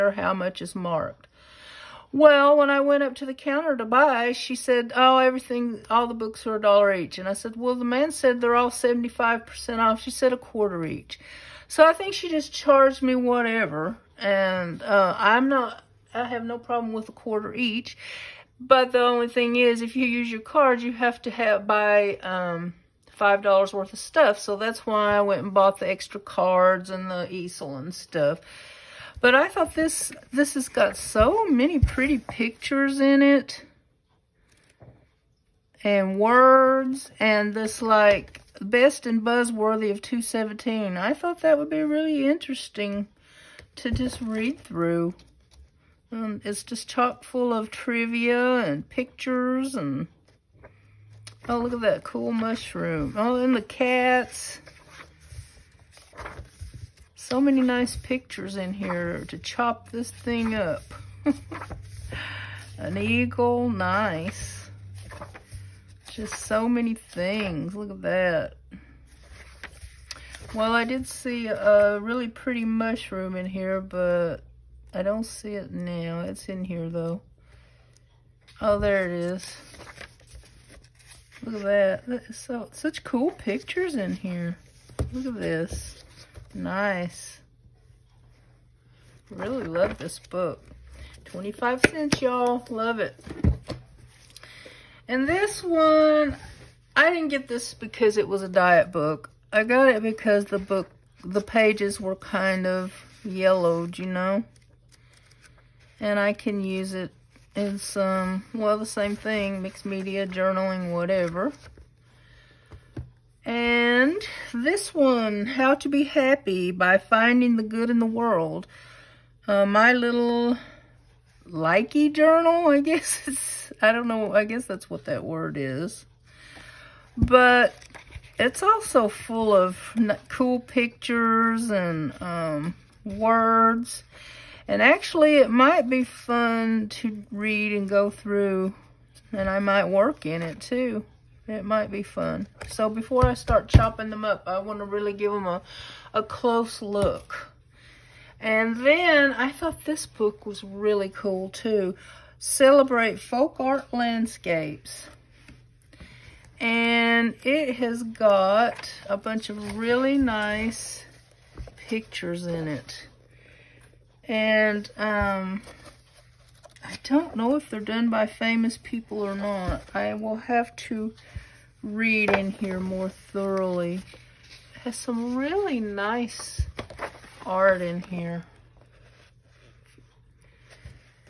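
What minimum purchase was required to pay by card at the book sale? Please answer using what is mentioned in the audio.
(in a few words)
$5.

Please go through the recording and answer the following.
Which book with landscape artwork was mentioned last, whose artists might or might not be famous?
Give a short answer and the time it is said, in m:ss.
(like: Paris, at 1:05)
Celebrate Folk Art Landscapes, at 2:32.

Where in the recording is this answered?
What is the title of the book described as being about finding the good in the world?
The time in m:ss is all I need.
1:55.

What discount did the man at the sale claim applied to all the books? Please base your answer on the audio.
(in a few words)
75%.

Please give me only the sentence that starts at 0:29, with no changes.
But I thought this, this has got so many pretty pictures in it.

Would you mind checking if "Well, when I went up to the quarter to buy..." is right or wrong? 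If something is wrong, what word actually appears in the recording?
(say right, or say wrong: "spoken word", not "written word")
wrong: "counter", not "quarter".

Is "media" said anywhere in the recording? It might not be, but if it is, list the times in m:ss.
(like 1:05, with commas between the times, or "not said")
1:49.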